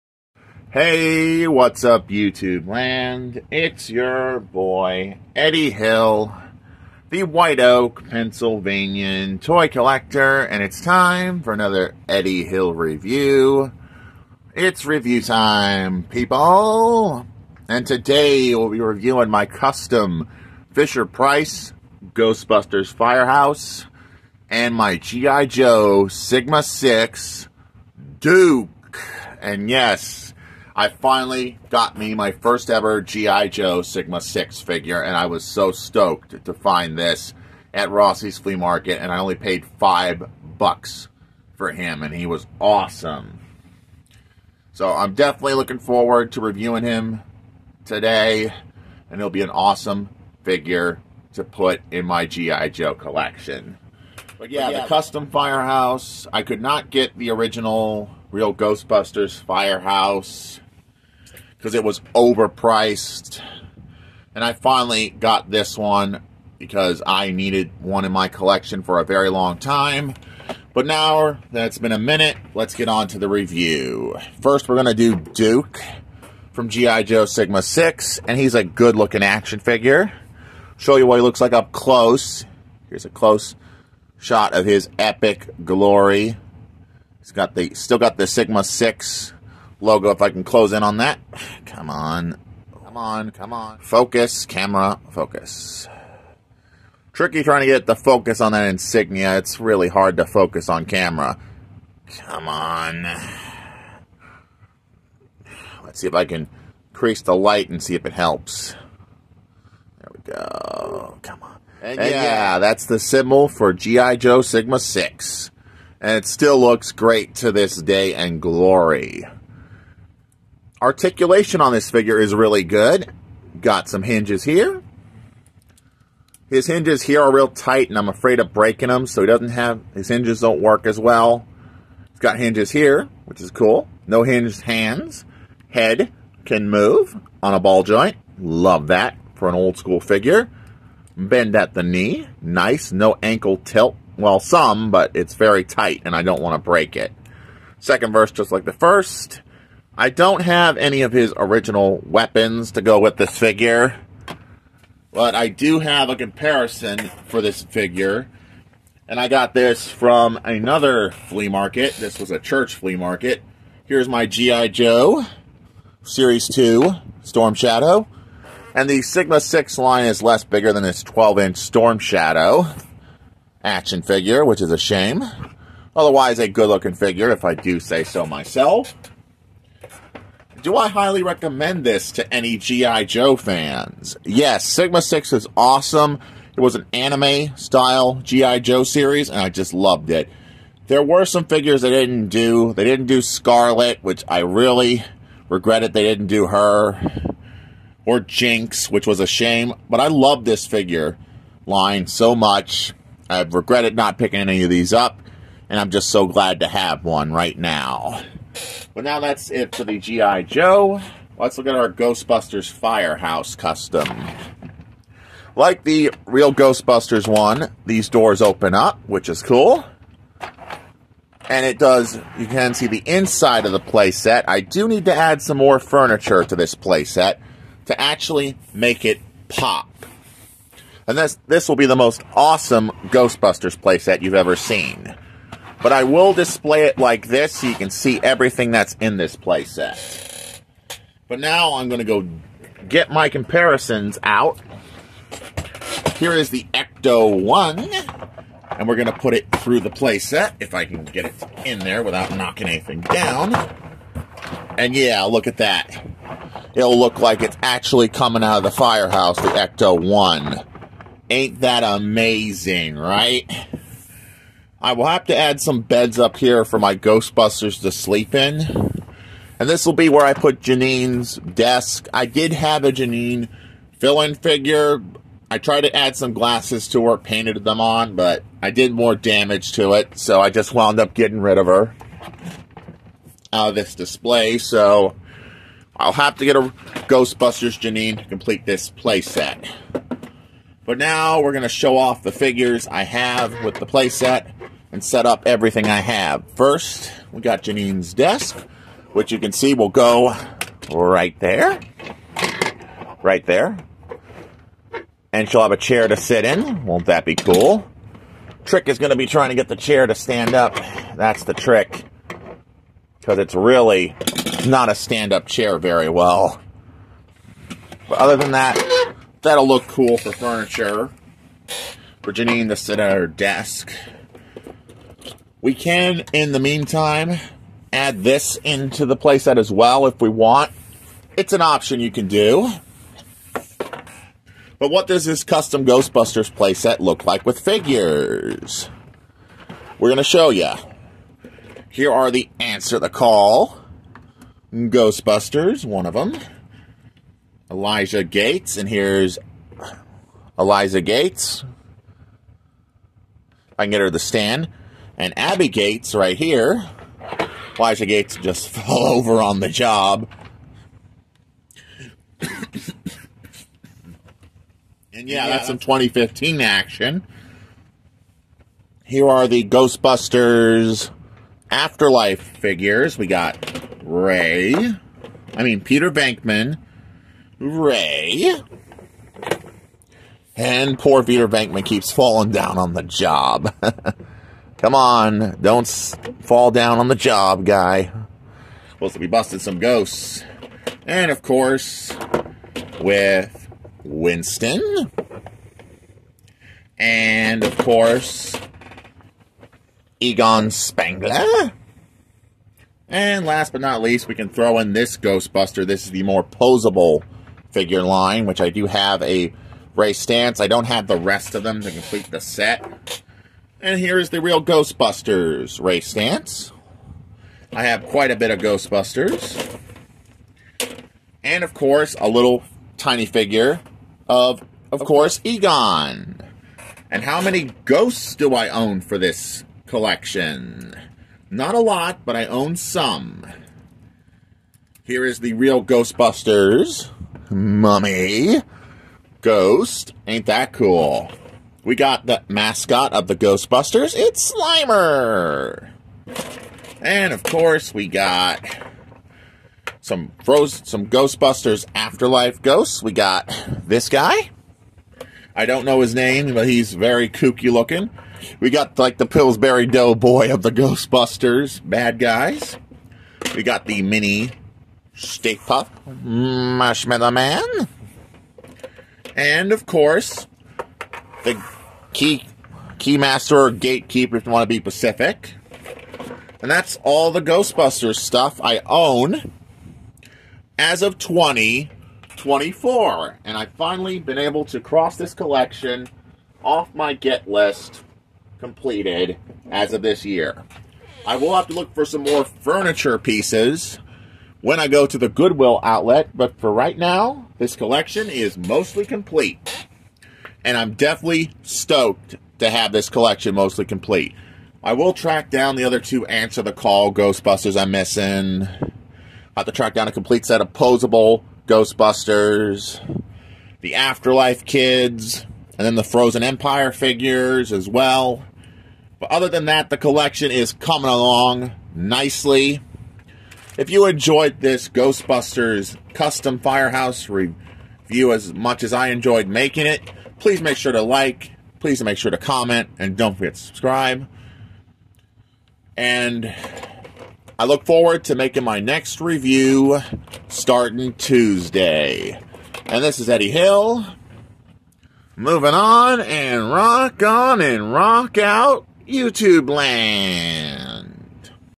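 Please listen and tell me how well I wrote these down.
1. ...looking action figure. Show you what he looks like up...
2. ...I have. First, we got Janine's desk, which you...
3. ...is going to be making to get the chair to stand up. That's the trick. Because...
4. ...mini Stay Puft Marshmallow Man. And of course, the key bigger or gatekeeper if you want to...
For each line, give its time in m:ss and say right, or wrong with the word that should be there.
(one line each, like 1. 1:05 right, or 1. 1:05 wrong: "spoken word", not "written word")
1. 1:18 right
2. 4:55 right
3. 5:08 wrong: "trying", not "making"
4. 7:44 wrong: "keymaster", not "bigger".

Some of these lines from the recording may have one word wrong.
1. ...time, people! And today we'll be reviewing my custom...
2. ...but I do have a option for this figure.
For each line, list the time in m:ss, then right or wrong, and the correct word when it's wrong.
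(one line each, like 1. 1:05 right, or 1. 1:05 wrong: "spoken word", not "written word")
1. 0:15 right
2. 2:35 wrong: "comparison", not "option".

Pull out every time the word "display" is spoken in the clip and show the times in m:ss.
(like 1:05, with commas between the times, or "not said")
3:56, 4:43.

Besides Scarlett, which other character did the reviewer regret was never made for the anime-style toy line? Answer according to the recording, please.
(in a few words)
Jinx.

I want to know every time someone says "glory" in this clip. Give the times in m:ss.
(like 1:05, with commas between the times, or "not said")
1:25, 1:58.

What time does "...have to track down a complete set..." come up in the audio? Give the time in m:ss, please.
8:29.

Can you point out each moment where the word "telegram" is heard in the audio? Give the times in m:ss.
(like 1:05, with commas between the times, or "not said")
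not said.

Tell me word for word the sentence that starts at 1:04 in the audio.
And I finally got this one because I needed one in my collection for a very long time.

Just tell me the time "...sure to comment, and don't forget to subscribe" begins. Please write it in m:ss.
8:52.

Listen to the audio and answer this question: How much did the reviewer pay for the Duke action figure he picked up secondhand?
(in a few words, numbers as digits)
$5.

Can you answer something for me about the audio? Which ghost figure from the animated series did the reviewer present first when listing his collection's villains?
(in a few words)
Mummy.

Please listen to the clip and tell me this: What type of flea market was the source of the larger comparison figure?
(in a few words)
A church flea market.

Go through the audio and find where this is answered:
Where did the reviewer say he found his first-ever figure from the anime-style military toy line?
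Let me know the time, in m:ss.
0:37.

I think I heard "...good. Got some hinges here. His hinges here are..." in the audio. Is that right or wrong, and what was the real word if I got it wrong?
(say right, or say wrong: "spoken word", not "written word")
right.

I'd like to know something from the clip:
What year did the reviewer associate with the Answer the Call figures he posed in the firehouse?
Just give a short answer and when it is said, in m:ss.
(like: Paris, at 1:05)
2015, at 6:05.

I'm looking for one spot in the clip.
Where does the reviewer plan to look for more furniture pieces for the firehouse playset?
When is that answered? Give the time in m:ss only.
8:15.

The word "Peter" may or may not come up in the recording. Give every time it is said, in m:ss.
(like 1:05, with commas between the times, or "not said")
6:15, 6:21.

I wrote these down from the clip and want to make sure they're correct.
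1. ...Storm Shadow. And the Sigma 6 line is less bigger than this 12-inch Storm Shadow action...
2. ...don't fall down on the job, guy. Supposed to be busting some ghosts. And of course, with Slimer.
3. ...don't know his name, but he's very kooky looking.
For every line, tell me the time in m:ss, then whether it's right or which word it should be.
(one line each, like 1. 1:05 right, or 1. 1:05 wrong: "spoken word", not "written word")
1. 2:47 right
2. 6:25 wrong: "Winston", not "Slimer"
3. 7:35 right.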